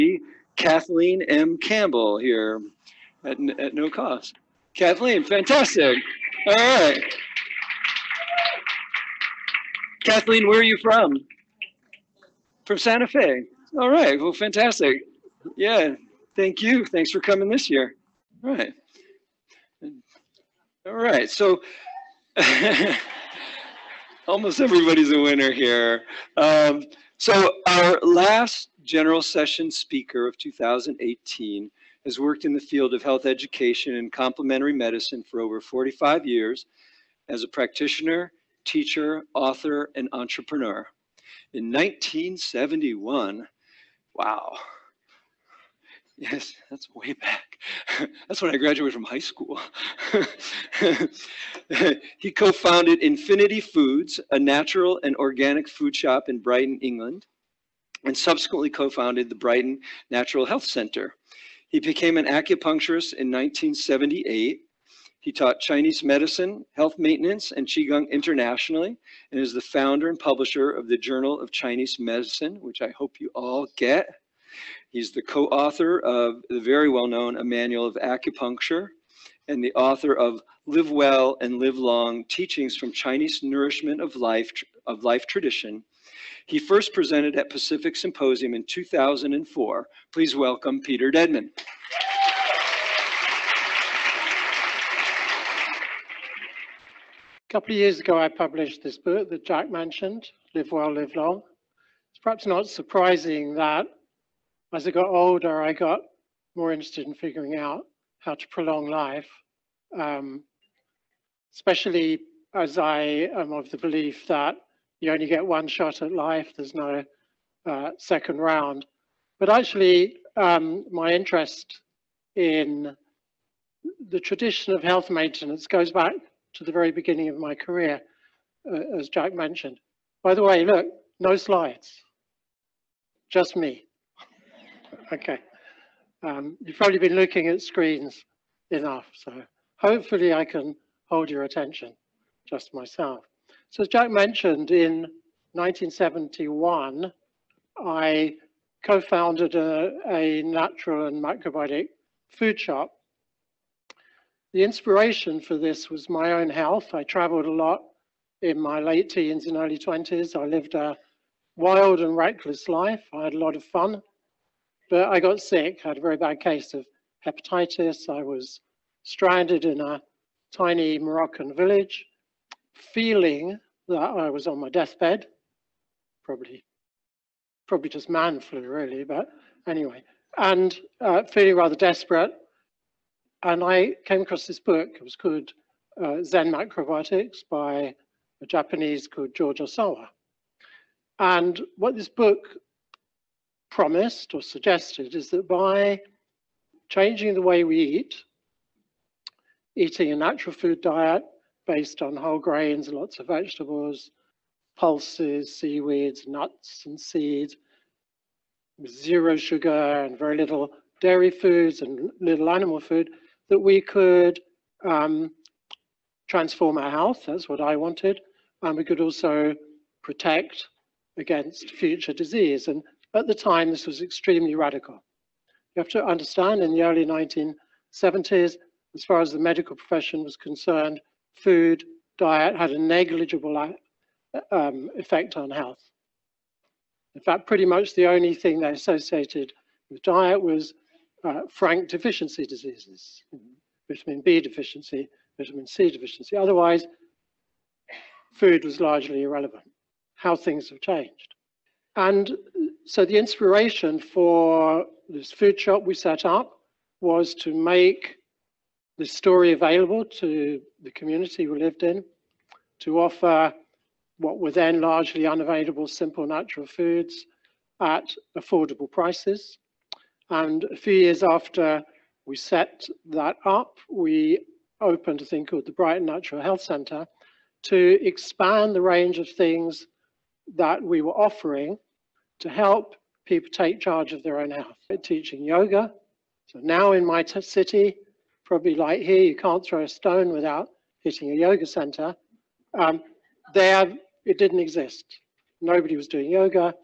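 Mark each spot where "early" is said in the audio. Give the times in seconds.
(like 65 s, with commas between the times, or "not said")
159 s, 226 s.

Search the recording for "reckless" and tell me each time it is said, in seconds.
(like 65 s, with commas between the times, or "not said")
162 s.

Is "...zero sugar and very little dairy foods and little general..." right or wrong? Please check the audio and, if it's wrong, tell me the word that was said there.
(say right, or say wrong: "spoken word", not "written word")
wrong: "animal", not "general".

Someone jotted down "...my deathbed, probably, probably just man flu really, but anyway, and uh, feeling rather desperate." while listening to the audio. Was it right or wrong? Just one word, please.
right.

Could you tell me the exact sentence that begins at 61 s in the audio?
He became an acupuncturist in 1978.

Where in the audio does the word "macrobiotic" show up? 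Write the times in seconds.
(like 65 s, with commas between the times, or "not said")
151 s, 186 s.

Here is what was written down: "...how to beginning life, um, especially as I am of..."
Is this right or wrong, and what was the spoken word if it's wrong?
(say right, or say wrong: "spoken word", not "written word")
wrong: "prolong", not "beginning".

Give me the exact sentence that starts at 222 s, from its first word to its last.
And at the time, this was extremely radical.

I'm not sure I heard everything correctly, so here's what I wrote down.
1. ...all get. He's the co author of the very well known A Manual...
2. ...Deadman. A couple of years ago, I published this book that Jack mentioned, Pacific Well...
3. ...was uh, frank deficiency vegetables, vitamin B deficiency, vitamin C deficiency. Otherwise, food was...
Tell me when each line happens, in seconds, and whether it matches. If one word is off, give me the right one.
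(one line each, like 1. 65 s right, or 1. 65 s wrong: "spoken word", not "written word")
1. 73 s right
2. 91 s wrong: "Live", not "Pacific"
3. 240 s wrong: "diseases", not "vegetables".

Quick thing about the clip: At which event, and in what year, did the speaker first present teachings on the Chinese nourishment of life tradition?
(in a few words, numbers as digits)
Pacific Symposium, 2004.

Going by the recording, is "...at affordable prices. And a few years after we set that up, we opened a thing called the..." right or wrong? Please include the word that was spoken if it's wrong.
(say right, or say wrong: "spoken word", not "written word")
right.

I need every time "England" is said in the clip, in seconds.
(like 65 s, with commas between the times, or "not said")
56 s.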